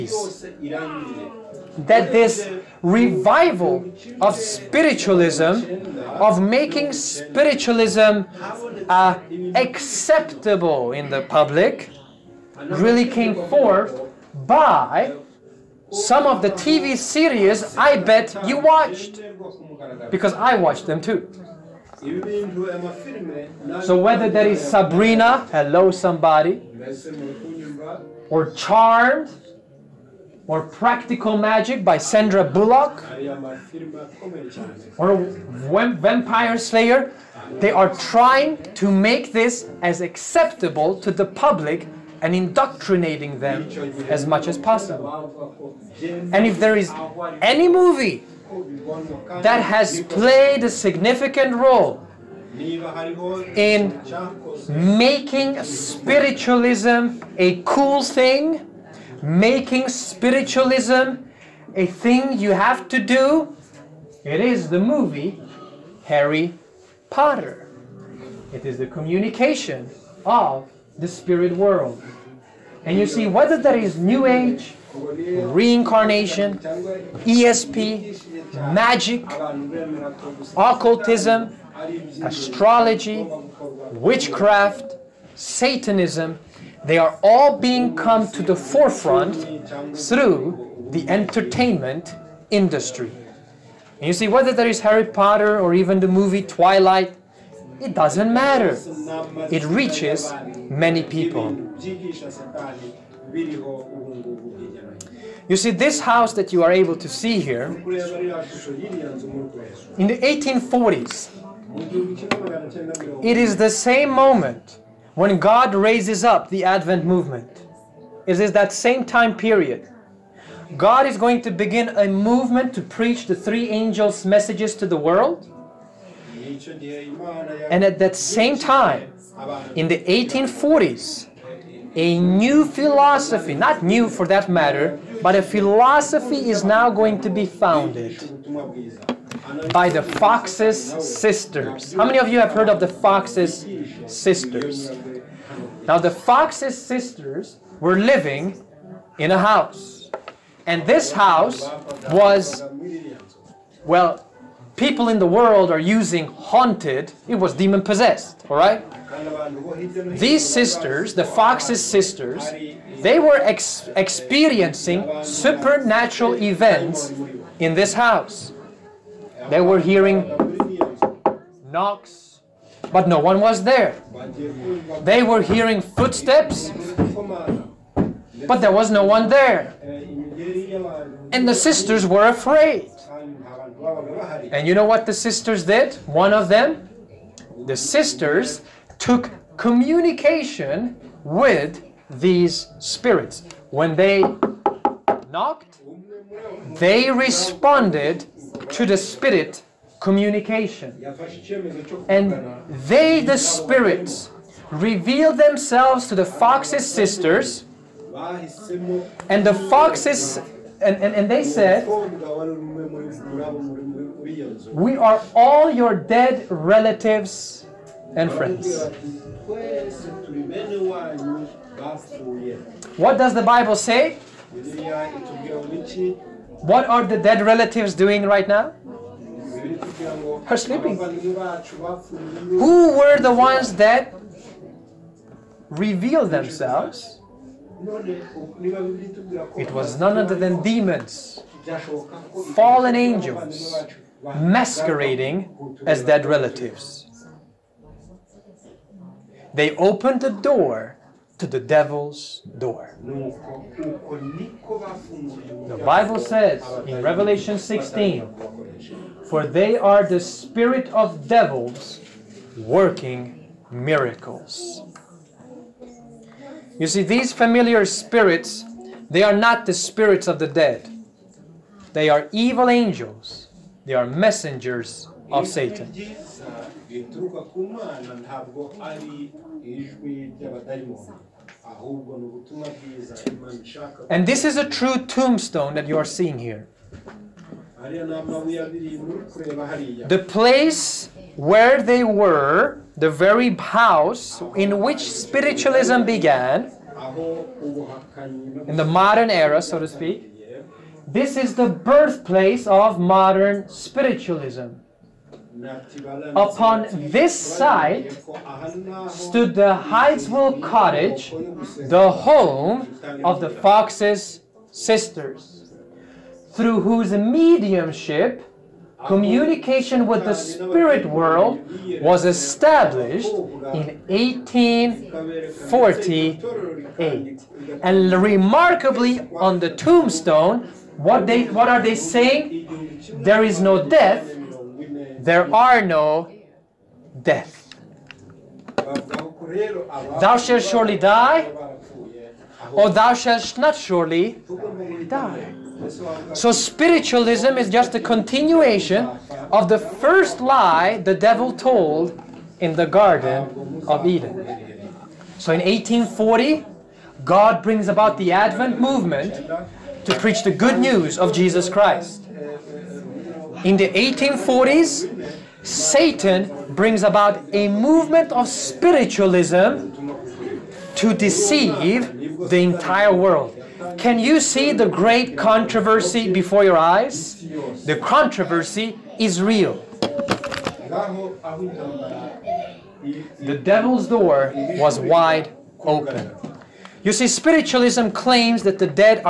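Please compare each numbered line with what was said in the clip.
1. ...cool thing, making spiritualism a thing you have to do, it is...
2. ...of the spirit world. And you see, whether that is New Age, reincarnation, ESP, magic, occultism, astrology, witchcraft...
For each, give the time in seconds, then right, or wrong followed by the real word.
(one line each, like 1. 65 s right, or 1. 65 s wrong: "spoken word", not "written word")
1. 57 s right
2. 70 s right.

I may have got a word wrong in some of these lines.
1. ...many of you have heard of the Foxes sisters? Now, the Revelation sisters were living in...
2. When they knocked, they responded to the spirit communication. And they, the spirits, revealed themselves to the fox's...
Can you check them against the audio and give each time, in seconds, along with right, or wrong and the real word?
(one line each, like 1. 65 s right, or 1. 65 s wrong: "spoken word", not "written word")
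1. 142 s wrong: "Foxes", not "Revelation"
2. 193 s right.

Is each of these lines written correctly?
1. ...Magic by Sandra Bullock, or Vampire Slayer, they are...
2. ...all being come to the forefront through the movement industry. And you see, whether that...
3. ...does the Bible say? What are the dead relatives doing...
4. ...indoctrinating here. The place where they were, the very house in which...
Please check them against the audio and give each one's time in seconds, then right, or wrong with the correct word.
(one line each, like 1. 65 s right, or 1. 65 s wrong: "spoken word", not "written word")
1. 31 s right
2. 87 s wrong: "entertainment", not "movement"
3. 223 s right
4. 286 s wrong: "seeing", not "indoctrinating".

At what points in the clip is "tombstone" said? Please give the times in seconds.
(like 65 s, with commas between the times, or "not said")
285 s, 329 s.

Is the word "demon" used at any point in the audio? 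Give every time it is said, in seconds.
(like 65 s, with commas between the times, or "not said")
157 s, 240 s.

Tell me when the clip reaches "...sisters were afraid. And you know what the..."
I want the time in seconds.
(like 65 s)
181 s.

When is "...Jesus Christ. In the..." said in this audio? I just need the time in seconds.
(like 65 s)
361 s.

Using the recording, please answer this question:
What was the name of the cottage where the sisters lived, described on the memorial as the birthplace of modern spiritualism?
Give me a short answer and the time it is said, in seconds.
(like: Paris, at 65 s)
Hydesville cottage, at 309 s.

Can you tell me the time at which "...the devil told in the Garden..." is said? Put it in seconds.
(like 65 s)
351 s.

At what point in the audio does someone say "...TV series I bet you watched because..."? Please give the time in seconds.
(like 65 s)
16 s.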